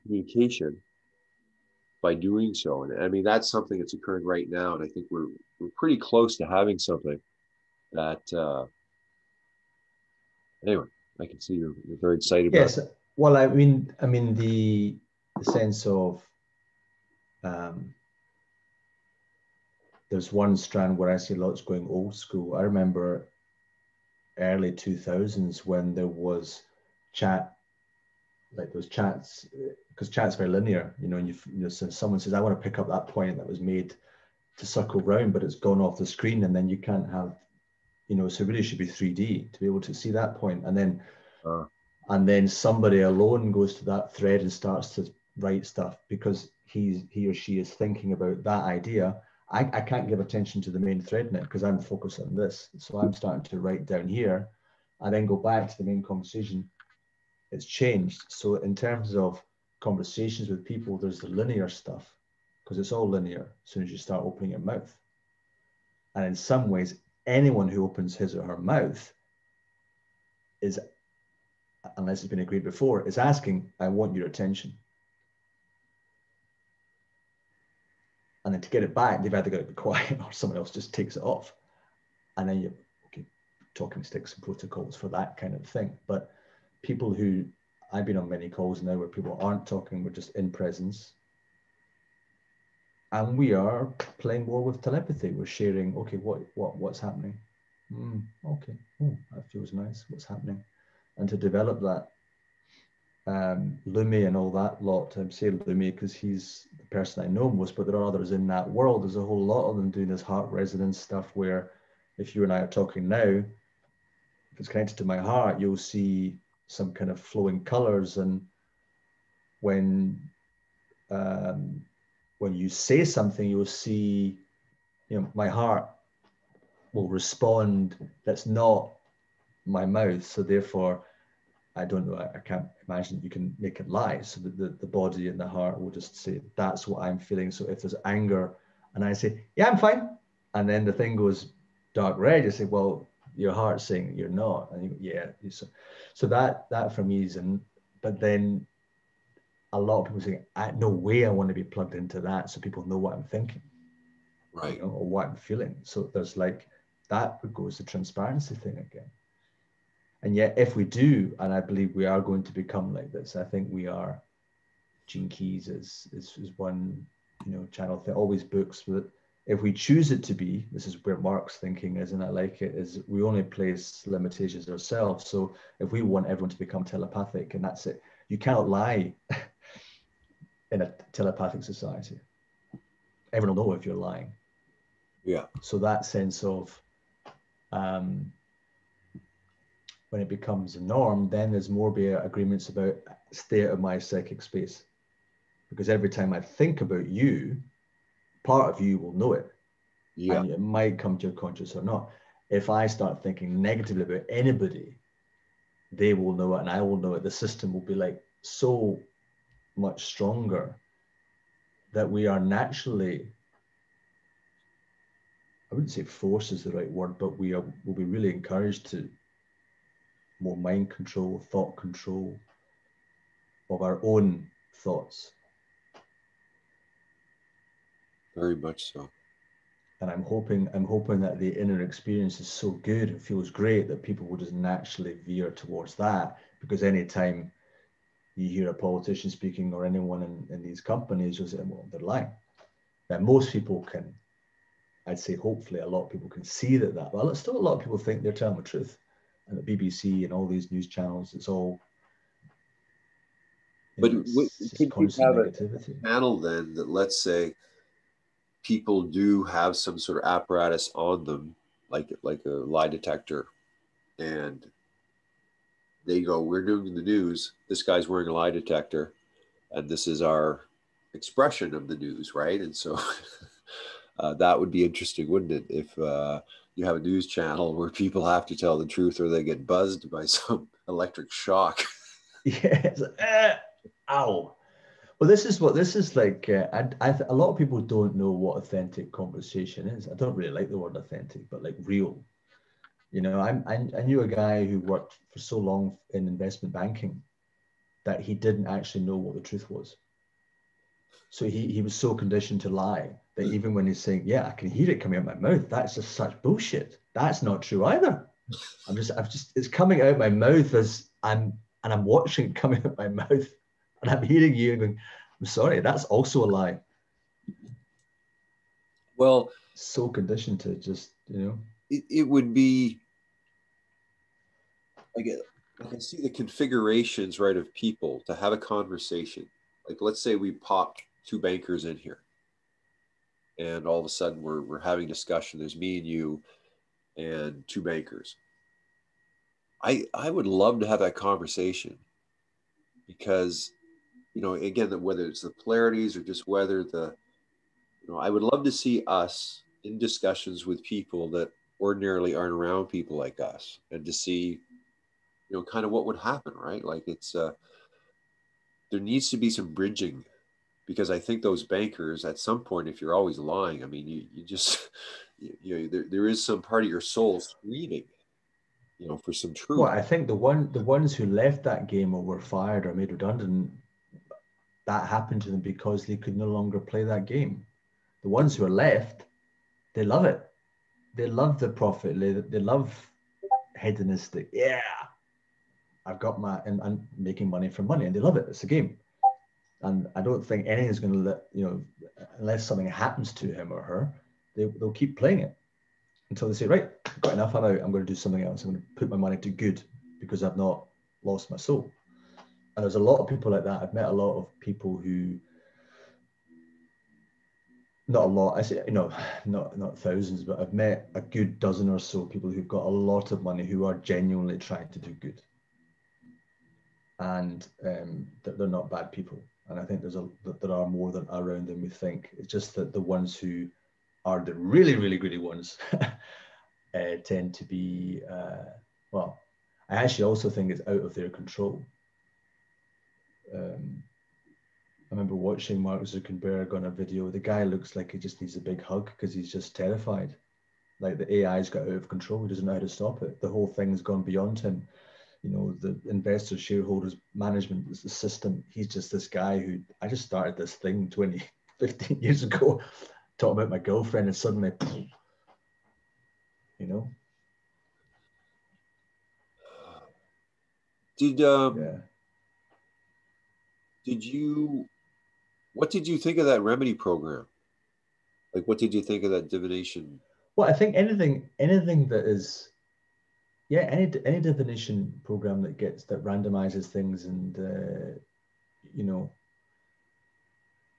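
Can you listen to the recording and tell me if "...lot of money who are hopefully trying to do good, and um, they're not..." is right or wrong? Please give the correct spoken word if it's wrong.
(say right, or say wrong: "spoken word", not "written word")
wrong: "genuinely", not "hopefully".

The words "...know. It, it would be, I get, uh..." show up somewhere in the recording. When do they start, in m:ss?
5:21.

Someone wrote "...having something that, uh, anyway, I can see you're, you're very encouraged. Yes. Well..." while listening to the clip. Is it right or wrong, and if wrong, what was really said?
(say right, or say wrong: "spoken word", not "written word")
wrong: "excited", not "encouraged".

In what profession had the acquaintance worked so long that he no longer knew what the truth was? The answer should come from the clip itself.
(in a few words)
investment banking.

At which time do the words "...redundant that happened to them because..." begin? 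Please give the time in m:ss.
6:13.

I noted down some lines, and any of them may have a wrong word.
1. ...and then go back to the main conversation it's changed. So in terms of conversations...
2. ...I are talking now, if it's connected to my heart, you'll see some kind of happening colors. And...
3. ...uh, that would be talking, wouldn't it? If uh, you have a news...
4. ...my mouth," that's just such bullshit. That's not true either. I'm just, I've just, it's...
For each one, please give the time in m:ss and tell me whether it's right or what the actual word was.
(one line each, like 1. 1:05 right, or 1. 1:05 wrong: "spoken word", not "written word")
1. 0:55 right
2. 1:52 wrong: "flowing", not "happening"
3. 4:34 wrong: "interesting", not "talking"
4. 5:05 right.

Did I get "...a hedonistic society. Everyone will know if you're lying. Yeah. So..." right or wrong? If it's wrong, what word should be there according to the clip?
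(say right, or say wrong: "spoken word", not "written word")
wrong: "telepathic", not "hedonistic".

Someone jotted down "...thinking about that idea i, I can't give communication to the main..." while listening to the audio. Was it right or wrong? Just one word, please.
wrong.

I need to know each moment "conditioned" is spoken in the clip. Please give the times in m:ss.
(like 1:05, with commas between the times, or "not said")
5:02, 5:20.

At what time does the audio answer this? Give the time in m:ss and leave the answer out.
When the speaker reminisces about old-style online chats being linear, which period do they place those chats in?
0:24.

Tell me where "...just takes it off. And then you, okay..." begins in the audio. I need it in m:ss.
1:20.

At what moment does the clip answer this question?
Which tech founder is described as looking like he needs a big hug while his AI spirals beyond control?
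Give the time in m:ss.
7:15.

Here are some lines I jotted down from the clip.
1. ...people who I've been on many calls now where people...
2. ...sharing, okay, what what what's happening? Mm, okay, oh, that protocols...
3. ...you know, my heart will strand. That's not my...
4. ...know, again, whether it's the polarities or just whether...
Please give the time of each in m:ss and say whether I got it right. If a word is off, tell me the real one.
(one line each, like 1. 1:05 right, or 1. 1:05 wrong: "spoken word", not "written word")
1. 1:26 right
2. 1:35 wrong: "feels", not "protocols"
3. 2:05 wrong: "respond", not "strand"
4. 5:44 right.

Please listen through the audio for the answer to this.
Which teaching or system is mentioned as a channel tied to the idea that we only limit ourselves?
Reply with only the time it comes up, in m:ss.
2:45.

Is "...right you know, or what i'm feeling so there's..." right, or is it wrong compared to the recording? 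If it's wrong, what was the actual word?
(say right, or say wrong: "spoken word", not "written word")
right.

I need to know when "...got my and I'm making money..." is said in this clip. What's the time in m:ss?
6:26.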